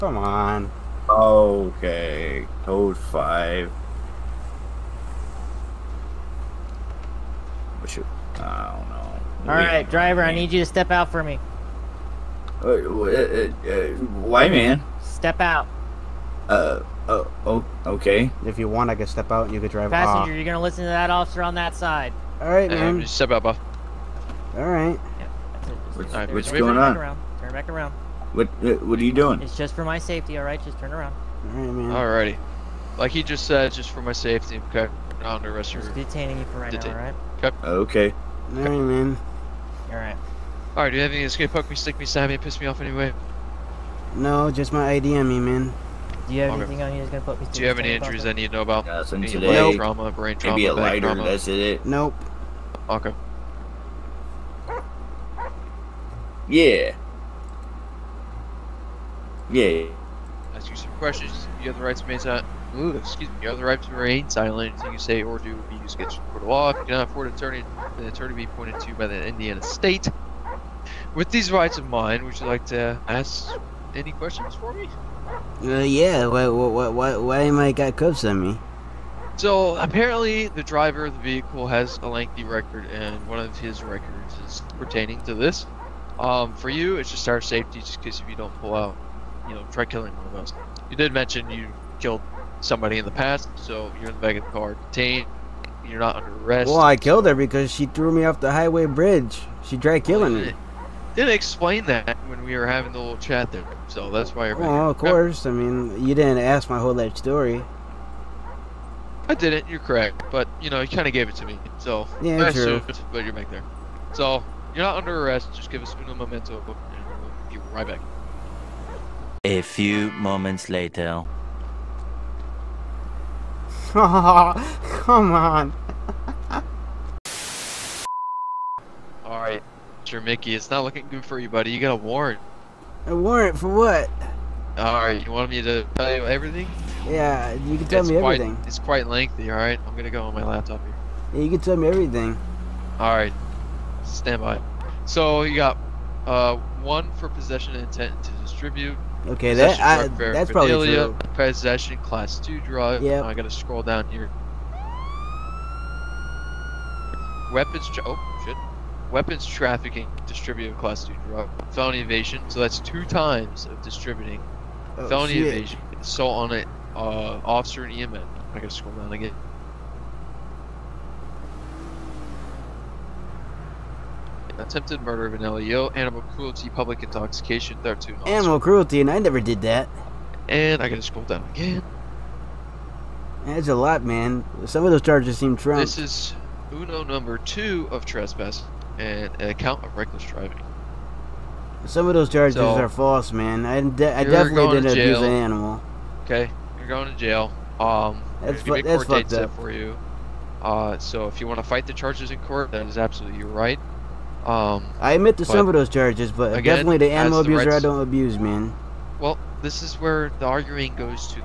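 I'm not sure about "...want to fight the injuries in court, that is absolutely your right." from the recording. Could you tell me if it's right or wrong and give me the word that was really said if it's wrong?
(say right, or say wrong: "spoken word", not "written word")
wrong: "charges", not "injuries".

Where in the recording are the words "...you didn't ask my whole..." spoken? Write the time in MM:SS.
01:46.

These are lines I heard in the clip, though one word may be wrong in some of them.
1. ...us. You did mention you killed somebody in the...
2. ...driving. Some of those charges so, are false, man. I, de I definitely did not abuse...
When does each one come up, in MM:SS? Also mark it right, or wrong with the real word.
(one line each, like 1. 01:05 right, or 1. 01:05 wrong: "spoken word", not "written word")
1. 01:30 right
2. 03:10 right.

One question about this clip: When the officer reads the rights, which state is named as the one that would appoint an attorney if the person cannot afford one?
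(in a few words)
Indiana.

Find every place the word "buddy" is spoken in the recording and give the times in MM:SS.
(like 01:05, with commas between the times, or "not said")
02:11.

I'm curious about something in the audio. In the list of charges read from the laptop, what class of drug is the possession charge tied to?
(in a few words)
class 2.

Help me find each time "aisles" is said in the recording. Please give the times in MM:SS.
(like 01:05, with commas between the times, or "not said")
not said.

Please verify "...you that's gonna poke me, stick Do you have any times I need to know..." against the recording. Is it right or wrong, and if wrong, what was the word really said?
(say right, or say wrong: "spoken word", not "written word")
wrong: "injuries", not "times".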